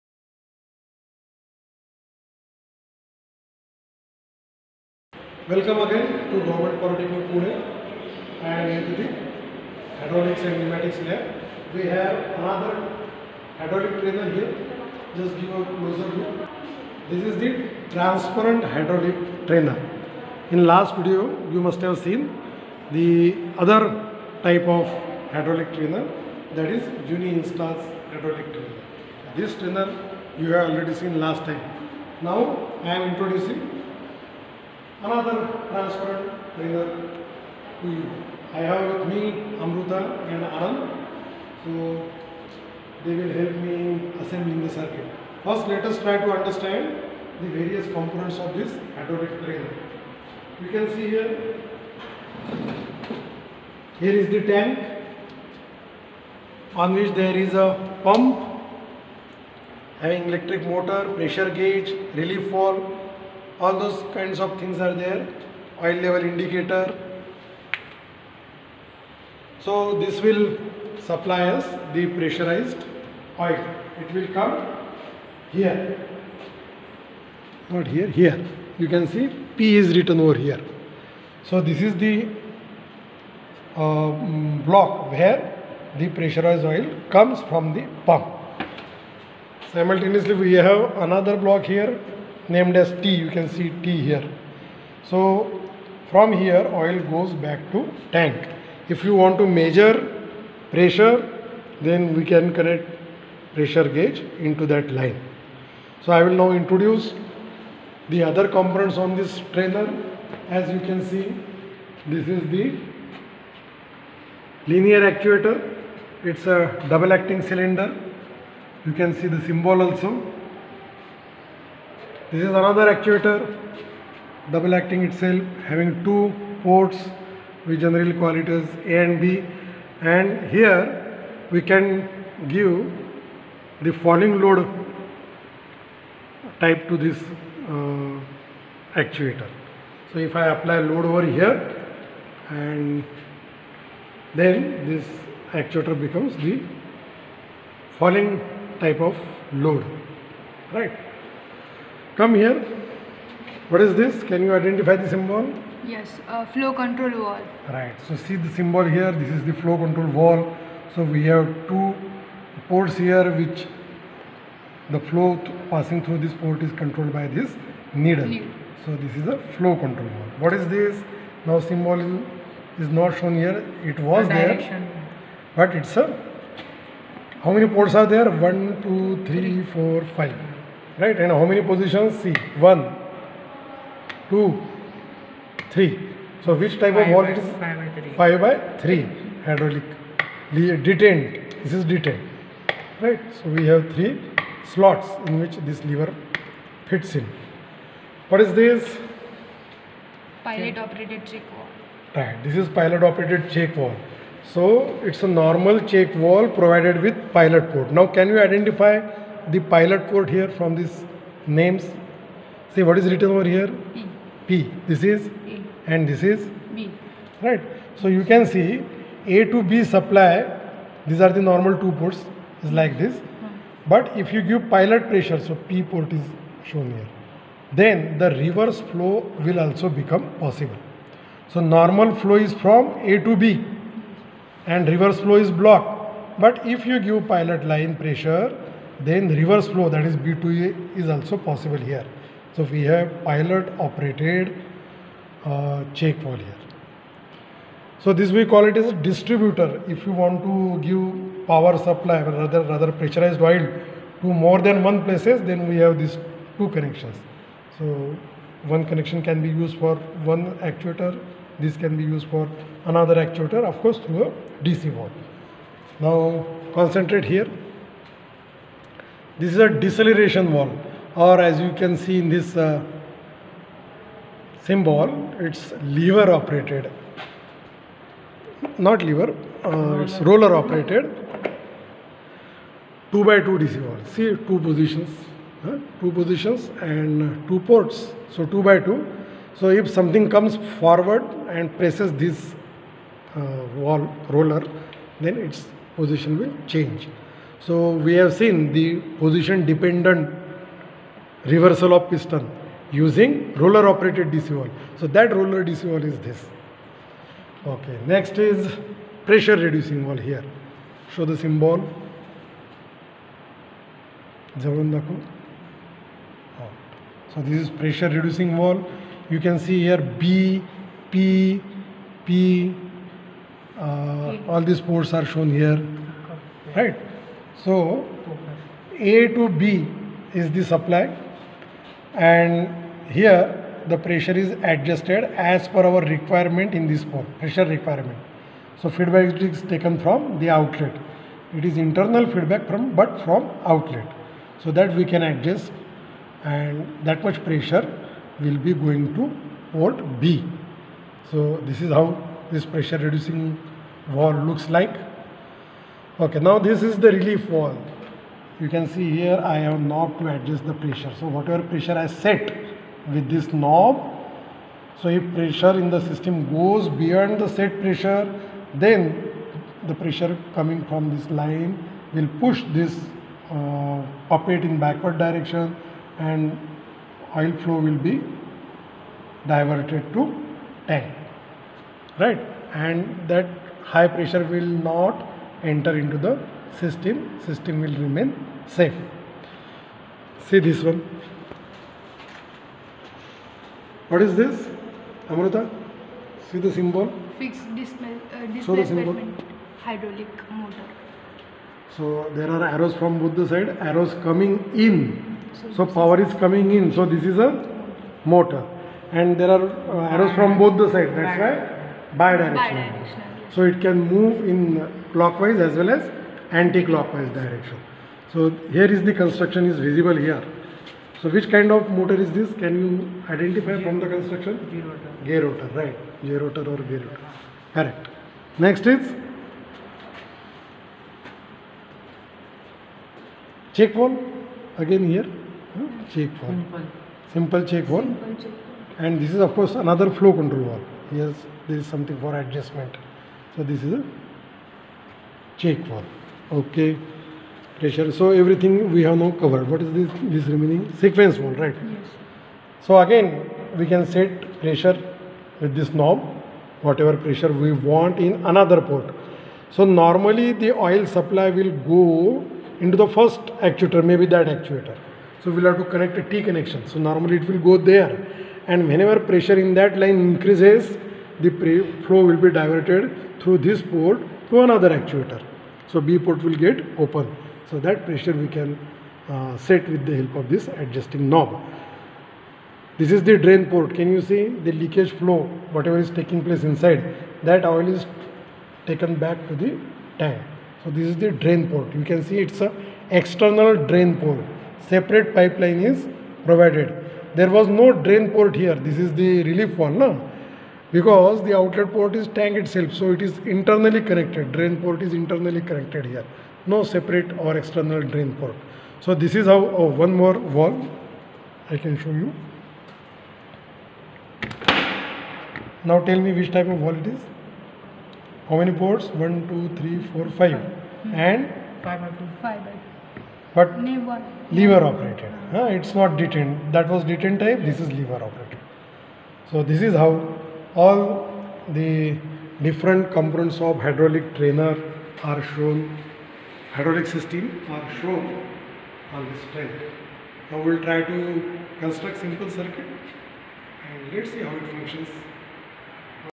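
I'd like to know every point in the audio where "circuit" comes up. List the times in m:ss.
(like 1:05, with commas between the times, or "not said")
0:44, 9:02.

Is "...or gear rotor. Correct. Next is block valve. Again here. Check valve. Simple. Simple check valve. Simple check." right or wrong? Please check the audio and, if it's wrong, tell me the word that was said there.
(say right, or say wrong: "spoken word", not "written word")
wrong: "check", not "block".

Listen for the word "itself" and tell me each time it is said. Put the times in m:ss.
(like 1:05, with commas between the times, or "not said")
2:05, 8:22.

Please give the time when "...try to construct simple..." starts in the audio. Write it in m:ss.
9:00.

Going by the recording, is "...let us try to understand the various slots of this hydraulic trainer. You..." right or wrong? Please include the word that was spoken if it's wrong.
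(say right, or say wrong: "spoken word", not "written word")
wrong: "components", not "slots".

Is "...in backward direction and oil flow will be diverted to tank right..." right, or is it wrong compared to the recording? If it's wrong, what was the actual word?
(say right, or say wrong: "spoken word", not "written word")
right.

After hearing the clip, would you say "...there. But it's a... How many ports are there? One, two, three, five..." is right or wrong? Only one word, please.
wrong.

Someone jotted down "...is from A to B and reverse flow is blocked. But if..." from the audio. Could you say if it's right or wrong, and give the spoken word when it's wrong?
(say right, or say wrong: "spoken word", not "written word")
right.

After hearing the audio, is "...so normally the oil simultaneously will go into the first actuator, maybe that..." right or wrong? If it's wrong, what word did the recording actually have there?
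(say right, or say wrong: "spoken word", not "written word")
wrong: "supply", not "simultaneously".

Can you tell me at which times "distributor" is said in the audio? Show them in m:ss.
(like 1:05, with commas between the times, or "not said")
4:08.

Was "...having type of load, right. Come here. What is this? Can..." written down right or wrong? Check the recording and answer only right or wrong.
wrong.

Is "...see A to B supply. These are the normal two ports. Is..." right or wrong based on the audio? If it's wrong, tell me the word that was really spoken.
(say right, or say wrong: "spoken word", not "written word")
right.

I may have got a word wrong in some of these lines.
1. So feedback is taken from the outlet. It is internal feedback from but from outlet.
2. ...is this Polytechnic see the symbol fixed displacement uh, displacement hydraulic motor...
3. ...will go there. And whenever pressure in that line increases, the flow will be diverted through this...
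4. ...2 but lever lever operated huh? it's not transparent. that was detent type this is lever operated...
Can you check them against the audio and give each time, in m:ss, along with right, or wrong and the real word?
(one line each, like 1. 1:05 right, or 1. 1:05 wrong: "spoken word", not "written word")
1. 5:38 right
2. 6:34 wrong: "Amruta", not "Polytechnic"
3. 7:47 right
4. 8:43 wrong: "detent", not "transparent".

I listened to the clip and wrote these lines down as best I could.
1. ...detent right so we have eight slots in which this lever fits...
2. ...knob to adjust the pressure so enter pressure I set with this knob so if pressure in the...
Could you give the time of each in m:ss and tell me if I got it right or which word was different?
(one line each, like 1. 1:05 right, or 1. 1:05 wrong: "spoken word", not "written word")
1. 3:11 wrong: "three", not "eight"
2. 5:59 wrong: "whatever", not "enter".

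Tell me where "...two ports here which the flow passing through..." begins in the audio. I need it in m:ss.
2:41.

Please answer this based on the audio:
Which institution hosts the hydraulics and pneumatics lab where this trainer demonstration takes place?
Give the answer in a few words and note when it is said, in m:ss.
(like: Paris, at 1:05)
Government Polytechnic Pune, at 0:06.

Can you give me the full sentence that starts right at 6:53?
so it can move in clockwise as well as anti-clockwise direction.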